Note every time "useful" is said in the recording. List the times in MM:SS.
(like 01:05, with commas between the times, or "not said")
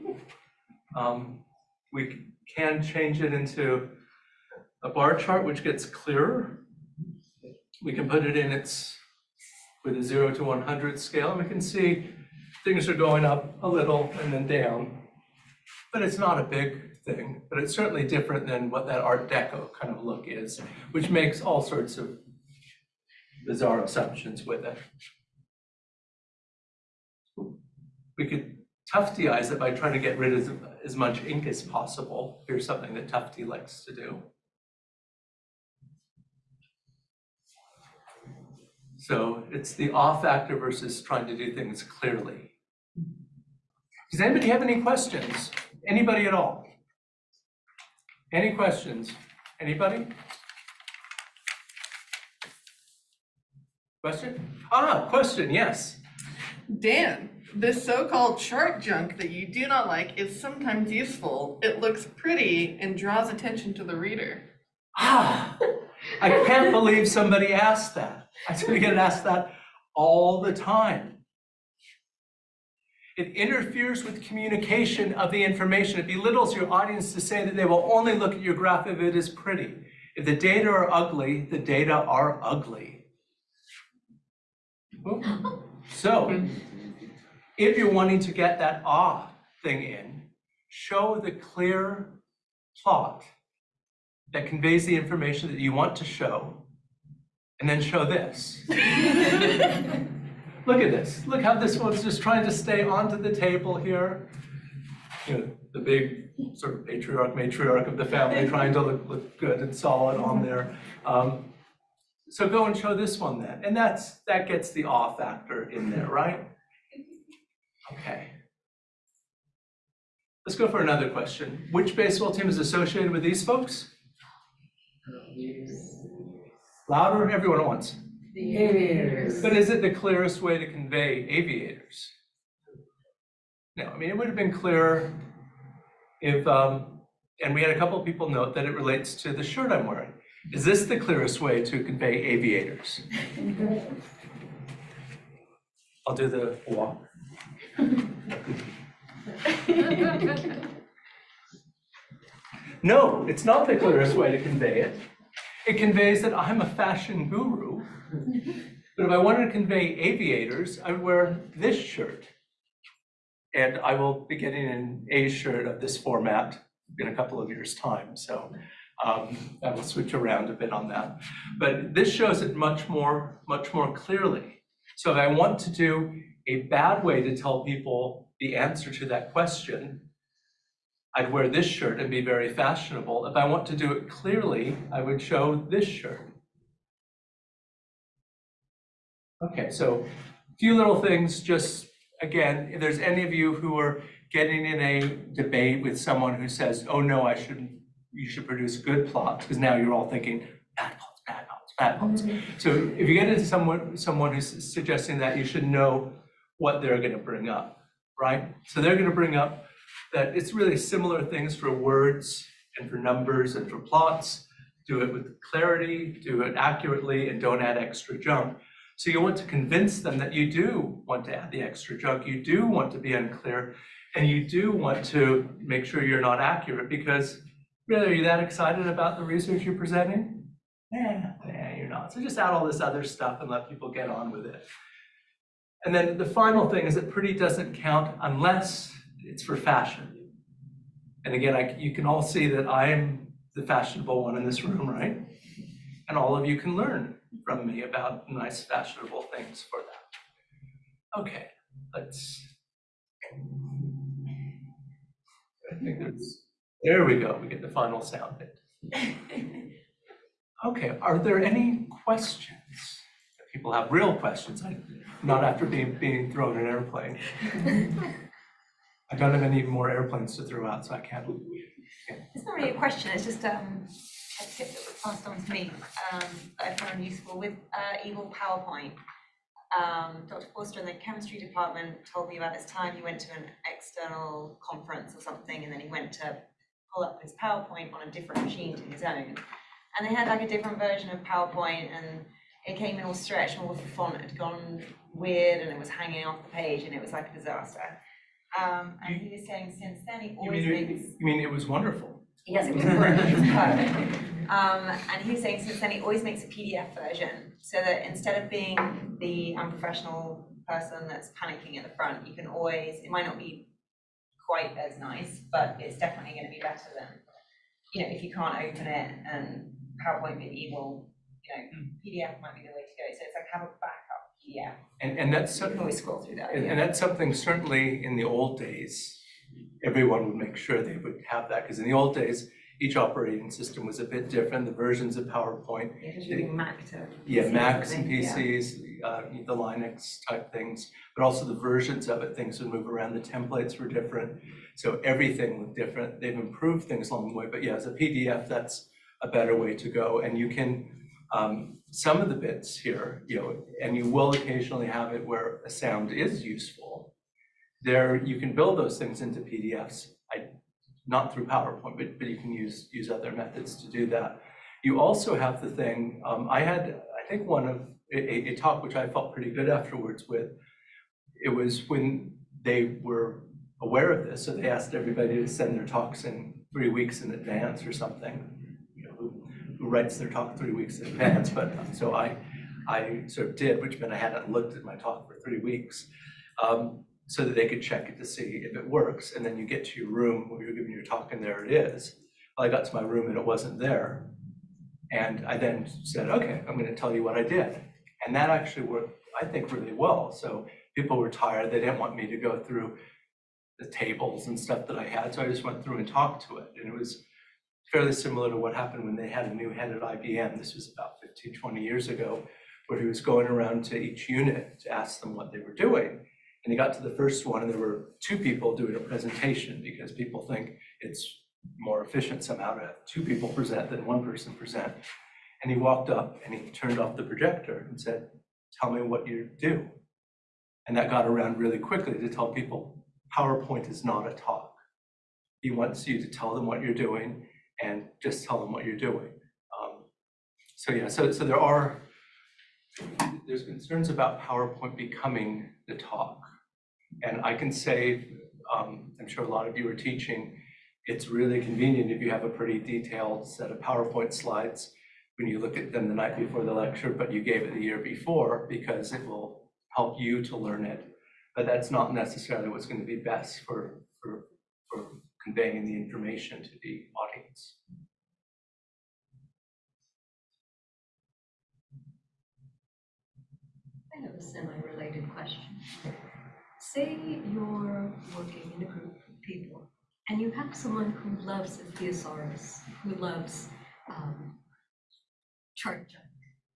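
01:00, 04:37, 05:56.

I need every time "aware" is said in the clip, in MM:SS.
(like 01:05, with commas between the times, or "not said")
06:13.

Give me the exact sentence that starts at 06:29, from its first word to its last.
And then you get to your room where you're giving your talk, and there it is.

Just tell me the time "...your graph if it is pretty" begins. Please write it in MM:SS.
01:18.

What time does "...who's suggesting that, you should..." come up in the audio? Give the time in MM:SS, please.
03:24.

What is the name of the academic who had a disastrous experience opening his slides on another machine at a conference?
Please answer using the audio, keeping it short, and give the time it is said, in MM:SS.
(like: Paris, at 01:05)
Dr. Forster, at 04:40.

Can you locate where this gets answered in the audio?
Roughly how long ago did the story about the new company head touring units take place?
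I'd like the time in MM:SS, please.
06:51.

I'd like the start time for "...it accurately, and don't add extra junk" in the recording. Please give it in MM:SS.
03:36.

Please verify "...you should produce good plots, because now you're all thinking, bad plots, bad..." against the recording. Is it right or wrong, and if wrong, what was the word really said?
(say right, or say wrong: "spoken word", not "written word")
right.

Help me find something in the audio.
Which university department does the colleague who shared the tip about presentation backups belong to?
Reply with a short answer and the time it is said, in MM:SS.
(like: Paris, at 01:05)
chemistry, at 04:40.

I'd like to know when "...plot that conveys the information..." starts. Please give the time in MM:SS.
01:32.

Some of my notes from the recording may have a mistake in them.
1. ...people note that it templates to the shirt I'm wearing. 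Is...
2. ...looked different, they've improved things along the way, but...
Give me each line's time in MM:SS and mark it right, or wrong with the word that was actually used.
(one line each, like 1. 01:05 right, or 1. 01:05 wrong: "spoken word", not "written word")
1. 02:18 wrong: "relates", not "templates"
2. 05:45 right.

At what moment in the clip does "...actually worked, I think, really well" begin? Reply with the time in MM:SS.
06:38.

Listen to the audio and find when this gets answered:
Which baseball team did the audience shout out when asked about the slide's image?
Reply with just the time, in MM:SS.
02:08.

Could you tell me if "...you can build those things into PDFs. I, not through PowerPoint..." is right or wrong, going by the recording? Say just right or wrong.
right.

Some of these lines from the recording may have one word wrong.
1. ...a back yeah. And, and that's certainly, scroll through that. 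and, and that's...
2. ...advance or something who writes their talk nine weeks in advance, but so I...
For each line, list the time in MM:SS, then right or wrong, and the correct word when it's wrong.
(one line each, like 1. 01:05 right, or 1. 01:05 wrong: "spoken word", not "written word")
1. 05:23 right
2. 06:17 wrong: "three", not "nine".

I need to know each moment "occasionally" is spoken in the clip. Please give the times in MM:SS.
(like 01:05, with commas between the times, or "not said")
05:54.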